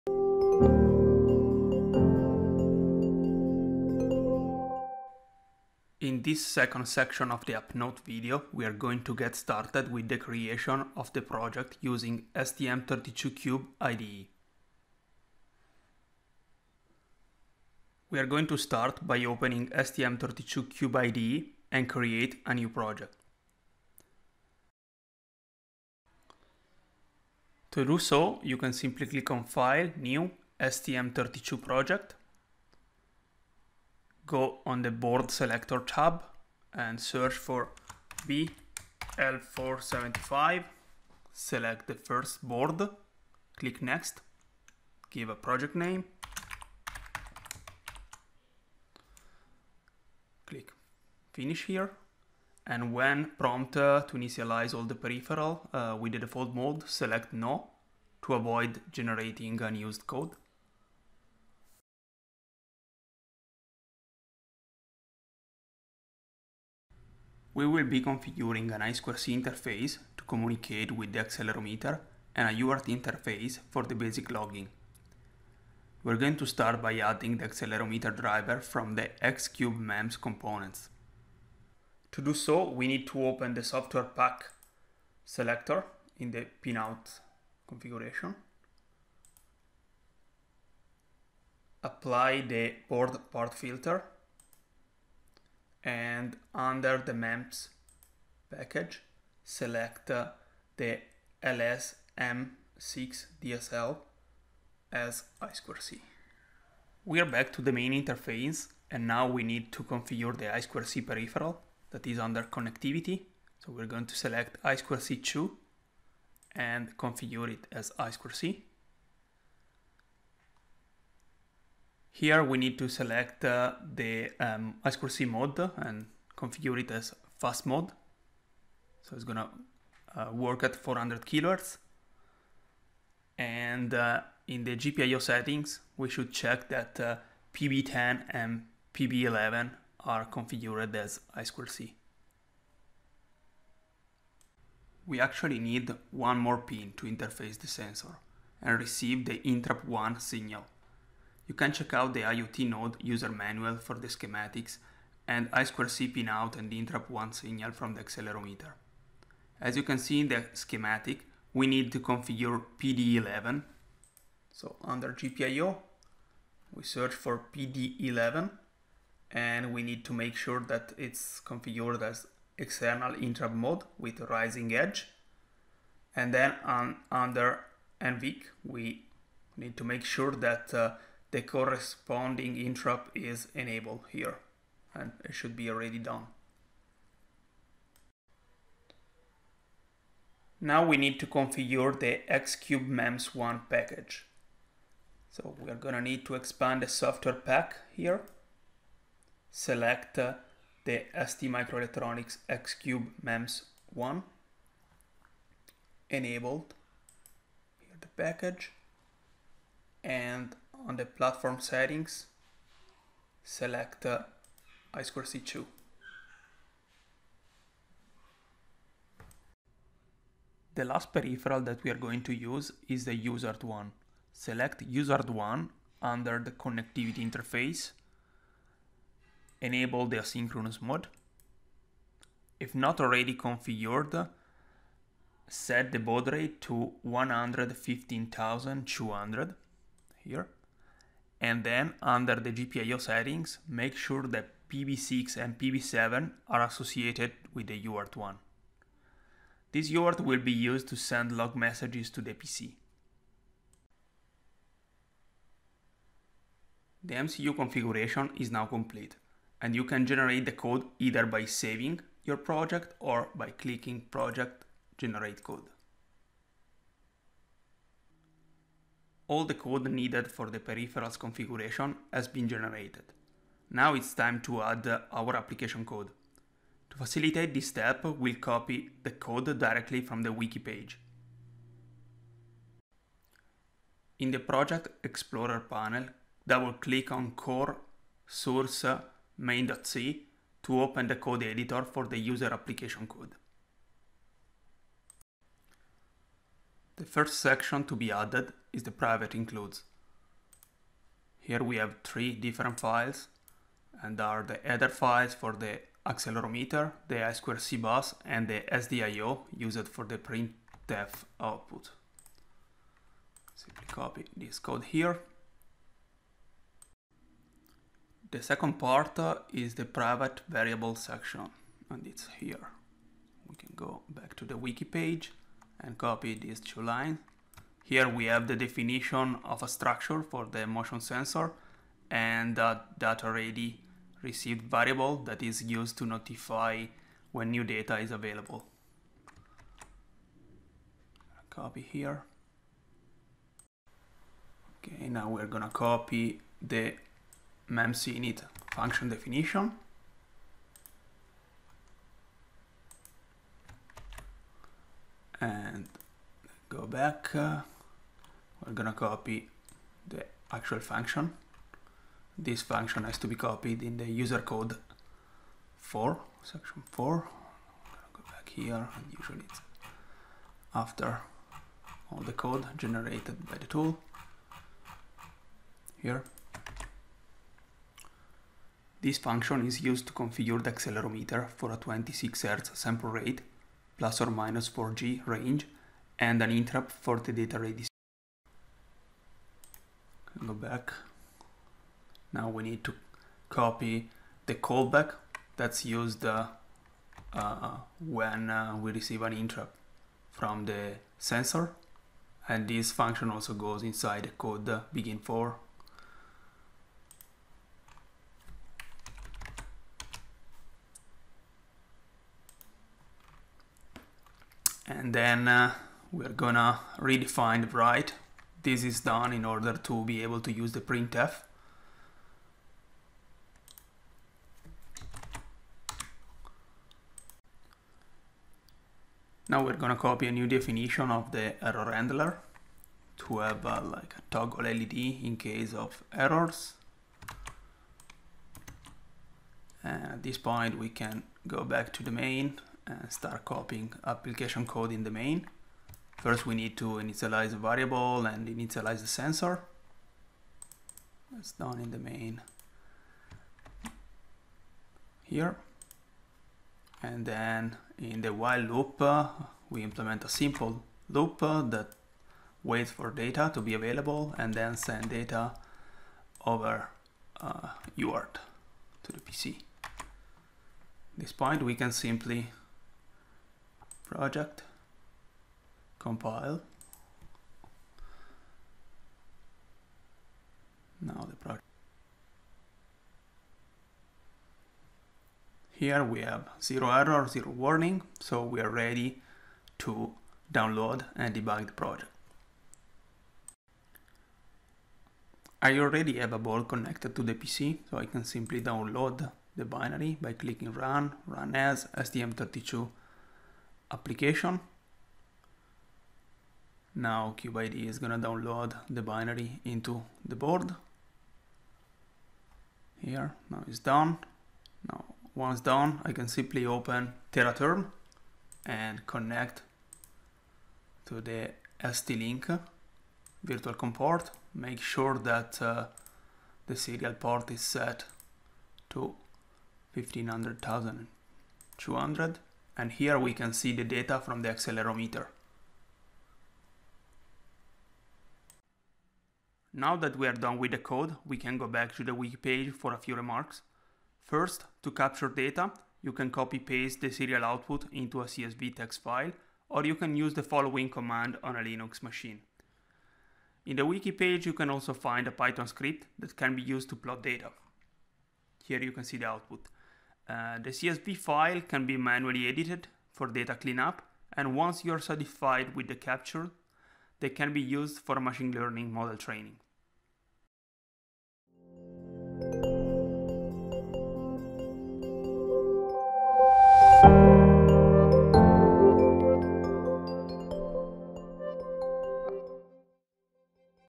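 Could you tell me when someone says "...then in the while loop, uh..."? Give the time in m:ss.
7:37.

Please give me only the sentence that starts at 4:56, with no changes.
The first section to be added is the private includes.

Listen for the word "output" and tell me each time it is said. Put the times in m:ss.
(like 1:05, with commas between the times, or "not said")
5:11, 9:07, 9:19.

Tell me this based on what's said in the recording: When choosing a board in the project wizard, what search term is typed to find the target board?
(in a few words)
BL475.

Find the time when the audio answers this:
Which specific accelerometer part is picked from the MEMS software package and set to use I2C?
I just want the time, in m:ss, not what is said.
1:41.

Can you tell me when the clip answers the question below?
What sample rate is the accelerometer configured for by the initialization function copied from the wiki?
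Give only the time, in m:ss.
6:21.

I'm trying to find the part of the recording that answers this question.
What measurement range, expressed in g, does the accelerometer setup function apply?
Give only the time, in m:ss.
6:23.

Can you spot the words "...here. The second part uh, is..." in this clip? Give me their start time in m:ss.
5:14.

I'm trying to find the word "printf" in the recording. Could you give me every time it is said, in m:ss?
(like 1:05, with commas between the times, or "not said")
5:10, 7:00.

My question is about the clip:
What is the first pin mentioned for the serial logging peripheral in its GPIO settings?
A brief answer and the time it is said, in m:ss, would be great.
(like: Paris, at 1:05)
PB6, at 4:04.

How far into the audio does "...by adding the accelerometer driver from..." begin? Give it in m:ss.
1:16.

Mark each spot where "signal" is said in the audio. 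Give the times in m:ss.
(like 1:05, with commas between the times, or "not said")
2:30, 2:37.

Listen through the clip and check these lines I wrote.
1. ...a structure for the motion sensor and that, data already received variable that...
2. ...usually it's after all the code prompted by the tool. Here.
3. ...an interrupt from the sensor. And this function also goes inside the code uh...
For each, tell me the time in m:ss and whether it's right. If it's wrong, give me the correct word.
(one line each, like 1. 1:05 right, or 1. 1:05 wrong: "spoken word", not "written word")
1. 5:29 right
2. 6:09 wrong: "generated", not "prompted"
3. 6:39 right.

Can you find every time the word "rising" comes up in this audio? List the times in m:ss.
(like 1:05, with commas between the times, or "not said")
2:54.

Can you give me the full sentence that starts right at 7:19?
And at this point we can go back to the main and start copying application code in the main.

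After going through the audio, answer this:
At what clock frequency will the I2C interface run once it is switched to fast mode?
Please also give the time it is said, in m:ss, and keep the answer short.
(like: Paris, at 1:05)
400 kilohertz, at 2:10.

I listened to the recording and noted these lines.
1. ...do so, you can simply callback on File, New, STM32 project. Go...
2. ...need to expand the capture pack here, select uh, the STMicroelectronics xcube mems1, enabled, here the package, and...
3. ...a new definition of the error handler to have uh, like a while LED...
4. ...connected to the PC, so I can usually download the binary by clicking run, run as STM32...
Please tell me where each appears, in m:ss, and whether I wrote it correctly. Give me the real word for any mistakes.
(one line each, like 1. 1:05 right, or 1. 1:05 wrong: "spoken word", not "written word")
1. 0:27 wrong: "click", not "callback"
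2. 3:16 wrong: "software", not "capture"
3. 7:10 wrong: "toggle", not "while"
4. 8:16 wrong: "simply", not "usually".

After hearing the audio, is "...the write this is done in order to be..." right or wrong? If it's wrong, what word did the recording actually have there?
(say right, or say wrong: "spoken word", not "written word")
right.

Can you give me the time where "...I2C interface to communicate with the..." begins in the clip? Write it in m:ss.
1:08.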